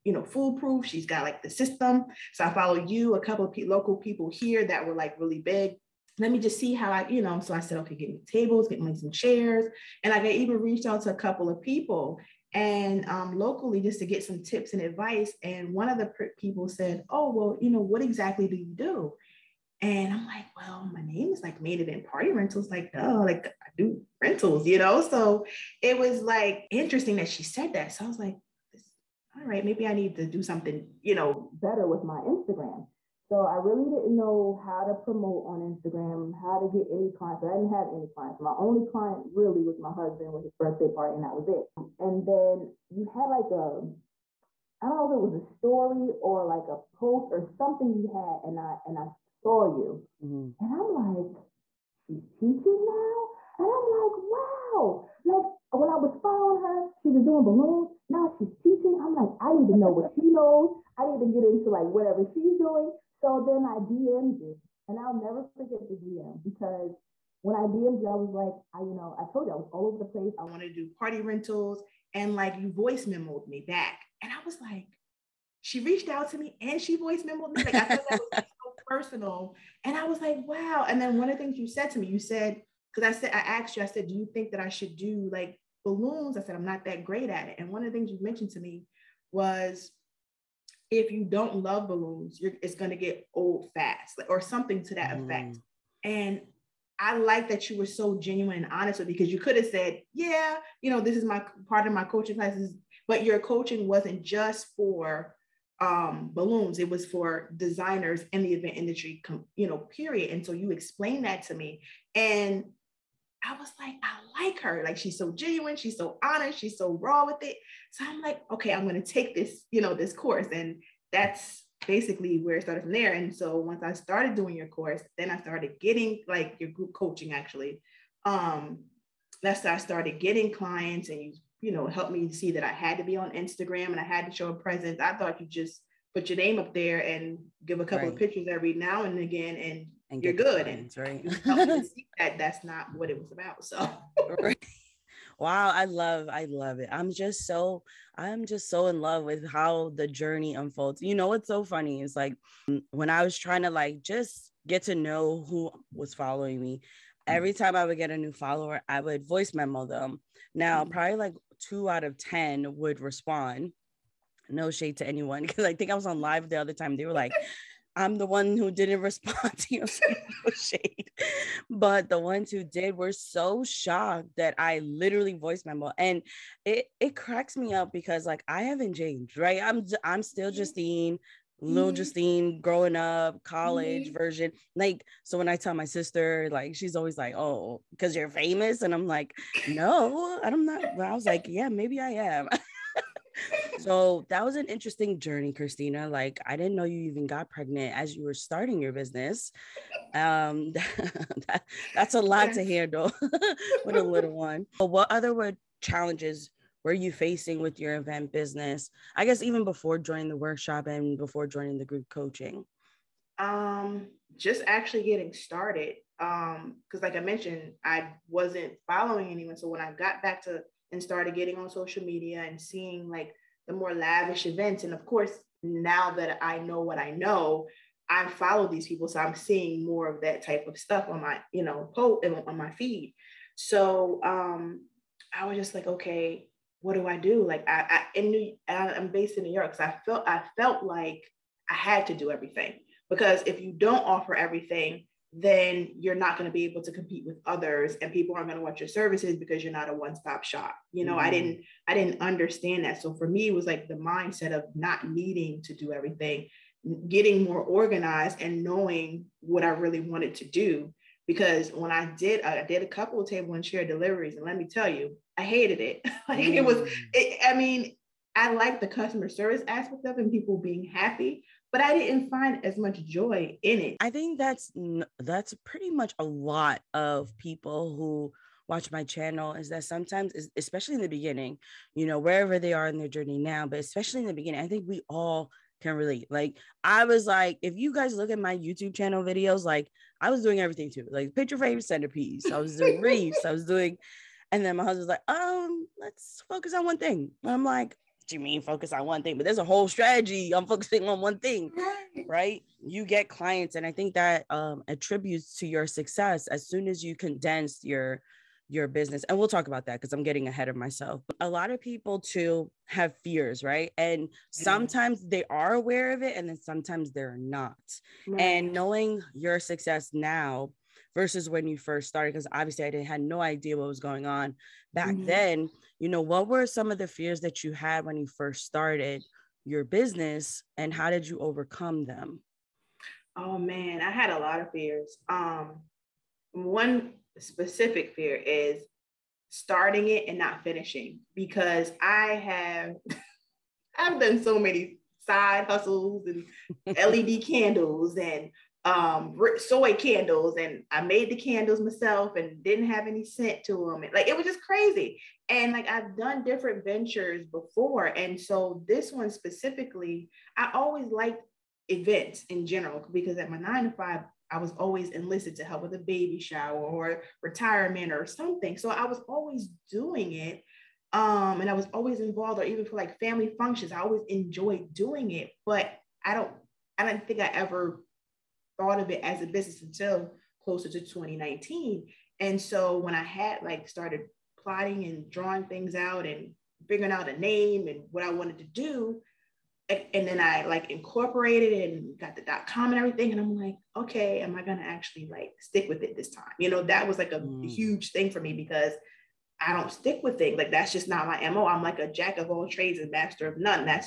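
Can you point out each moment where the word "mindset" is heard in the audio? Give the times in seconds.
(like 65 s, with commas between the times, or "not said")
253 s.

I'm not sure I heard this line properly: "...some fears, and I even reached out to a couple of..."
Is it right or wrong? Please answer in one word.
wrong.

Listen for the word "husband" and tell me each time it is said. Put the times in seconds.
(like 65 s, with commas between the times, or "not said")
39 s, 294 s.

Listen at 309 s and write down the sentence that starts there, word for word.
And we'll talk about that because I'm getting ahead of myself.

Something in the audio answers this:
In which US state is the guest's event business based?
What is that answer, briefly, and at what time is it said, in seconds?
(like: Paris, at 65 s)
New York, at 239 s.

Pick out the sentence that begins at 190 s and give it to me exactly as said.
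But I was like, yeah, maybe I am.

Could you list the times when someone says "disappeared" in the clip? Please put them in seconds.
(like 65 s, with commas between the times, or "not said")
not said.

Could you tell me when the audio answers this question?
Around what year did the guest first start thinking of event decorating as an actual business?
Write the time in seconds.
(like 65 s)
381 s.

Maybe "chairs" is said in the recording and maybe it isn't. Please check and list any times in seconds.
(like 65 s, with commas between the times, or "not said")
9 s, 263 s.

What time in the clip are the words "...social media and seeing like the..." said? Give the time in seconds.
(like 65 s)
221 s.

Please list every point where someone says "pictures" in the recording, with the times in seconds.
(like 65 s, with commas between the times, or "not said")
138 s, 291 s.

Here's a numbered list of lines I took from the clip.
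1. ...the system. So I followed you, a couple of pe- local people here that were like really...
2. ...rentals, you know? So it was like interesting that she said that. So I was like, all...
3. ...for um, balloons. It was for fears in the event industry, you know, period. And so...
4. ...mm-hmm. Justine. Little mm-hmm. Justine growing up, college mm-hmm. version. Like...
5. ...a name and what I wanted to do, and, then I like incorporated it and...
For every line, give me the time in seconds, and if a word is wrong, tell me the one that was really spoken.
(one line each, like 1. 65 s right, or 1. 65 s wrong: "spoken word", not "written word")
1. 1 s right
2. 24 s right
3. 104 s wrong: "designers", not "fears"
4. 180 s right
5. 387 s right.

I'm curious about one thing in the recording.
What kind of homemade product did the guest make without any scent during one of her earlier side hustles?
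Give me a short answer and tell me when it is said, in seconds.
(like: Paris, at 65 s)
Soy candles, at 349 s.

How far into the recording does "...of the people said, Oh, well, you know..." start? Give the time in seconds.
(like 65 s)
15 s.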